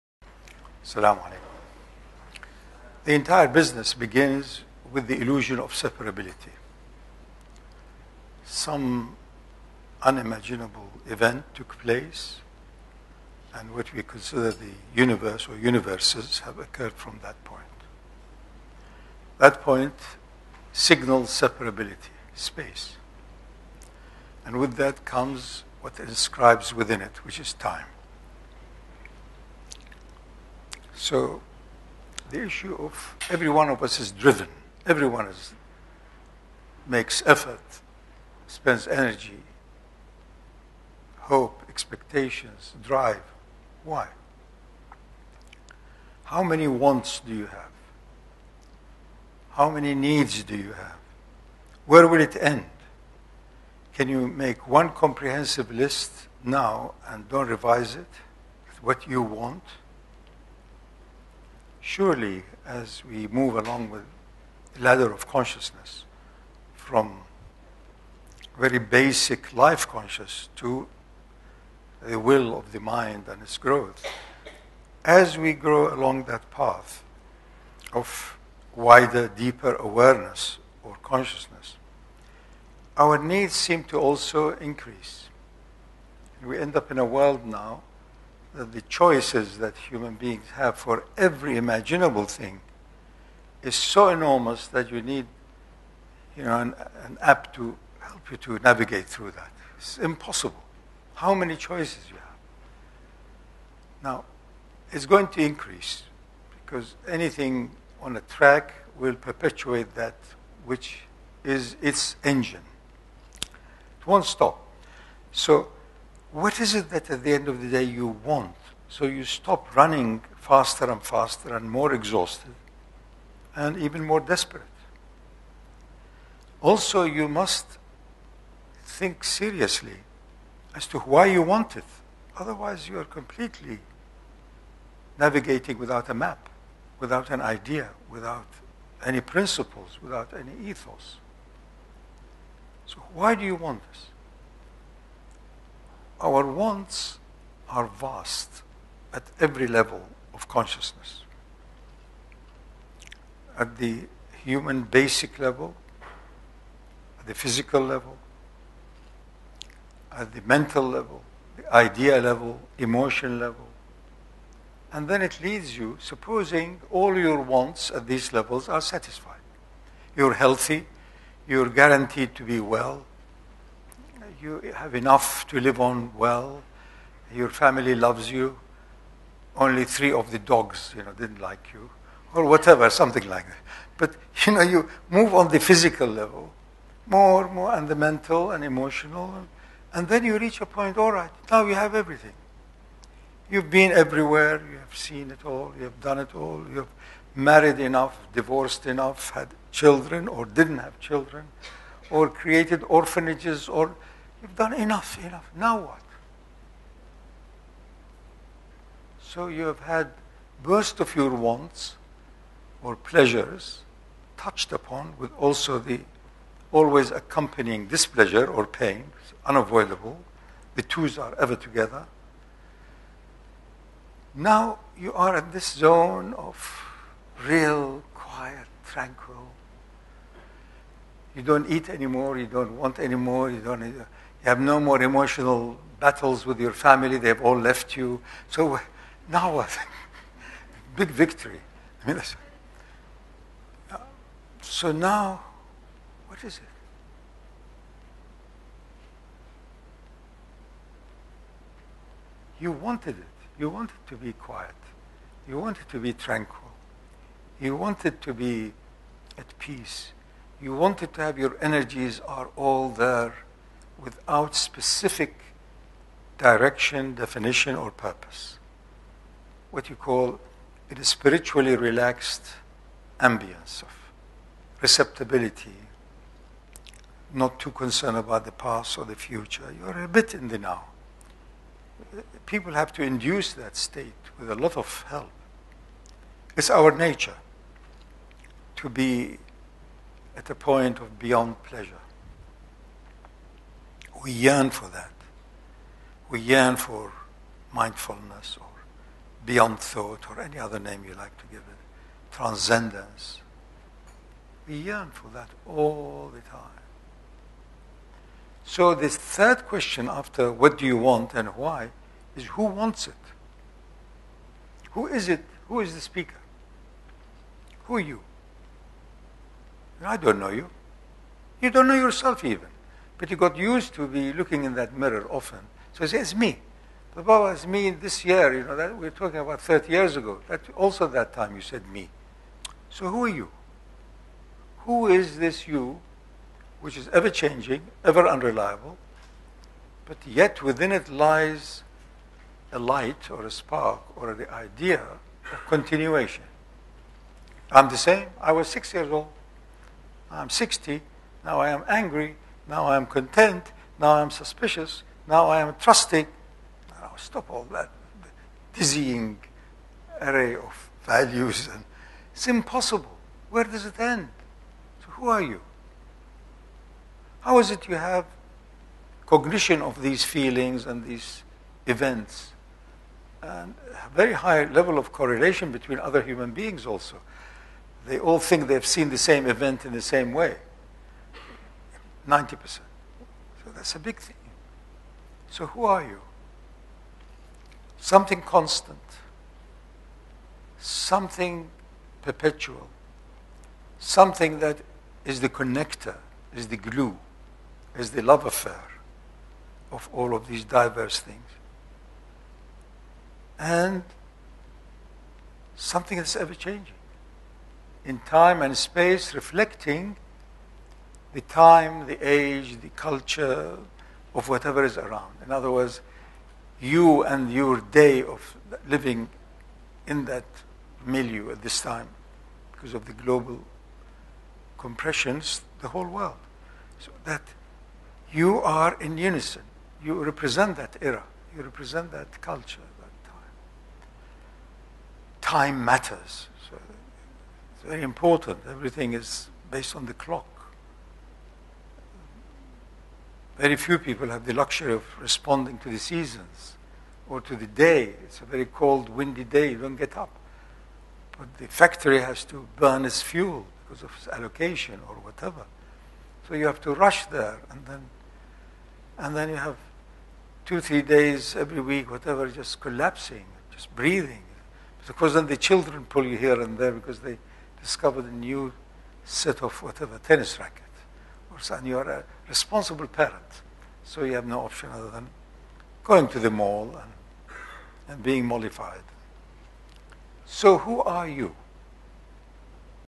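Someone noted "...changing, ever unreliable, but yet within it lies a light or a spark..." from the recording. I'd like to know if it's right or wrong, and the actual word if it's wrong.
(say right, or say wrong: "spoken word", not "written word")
right.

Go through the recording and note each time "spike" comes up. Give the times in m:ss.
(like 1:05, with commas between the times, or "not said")
not said.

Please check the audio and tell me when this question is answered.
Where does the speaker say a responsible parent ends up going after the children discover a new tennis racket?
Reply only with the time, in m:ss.
7:56.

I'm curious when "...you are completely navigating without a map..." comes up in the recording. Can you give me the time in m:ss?
2:12.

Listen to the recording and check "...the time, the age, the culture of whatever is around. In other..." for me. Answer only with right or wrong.
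right.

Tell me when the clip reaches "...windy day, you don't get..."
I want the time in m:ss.
7:29.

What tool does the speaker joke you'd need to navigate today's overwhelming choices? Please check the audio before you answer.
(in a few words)
An app.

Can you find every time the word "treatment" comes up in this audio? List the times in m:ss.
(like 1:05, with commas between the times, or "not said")
not said.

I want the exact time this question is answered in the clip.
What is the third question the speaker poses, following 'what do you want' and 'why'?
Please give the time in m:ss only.
5:12.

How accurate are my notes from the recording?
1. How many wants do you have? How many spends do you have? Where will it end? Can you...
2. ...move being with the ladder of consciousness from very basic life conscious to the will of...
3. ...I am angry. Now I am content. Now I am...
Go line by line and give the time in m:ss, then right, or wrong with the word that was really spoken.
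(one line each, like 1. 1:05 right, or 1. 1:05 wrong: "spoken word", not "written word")
1. 0:46 wrong: "needs", not "spends"
2. 1:03 wrong: "along", not "being"
3. 5:51 right.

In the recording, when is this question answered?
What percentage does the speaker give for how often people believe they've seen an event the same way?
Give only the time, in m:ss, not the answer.
6:22.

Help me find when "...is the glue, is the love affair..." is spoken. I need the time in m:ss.
6:36.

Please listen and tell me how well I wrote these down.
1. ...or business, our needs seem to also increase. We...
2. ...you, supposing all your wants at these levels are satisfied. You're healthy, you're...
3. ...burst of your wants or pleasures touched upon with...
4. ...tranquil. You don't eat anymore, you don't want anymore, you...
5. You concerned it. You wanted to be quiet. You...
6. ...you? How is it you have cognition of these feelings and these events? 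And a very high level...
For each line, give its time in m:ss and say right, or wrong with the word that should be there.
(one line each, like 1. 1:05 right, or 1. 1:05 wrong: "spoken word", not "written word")
1. 1:20 wrong: "consciousness", not "business"
2. 2:45 right
3. 3:30 right
4. 3:48 right
5. 4:12 wrong: "wanted", not "concerned"
6. 6:05 right.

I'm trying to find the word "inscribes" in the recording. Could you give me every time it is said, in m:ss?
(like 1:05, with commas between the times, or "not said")
0:25.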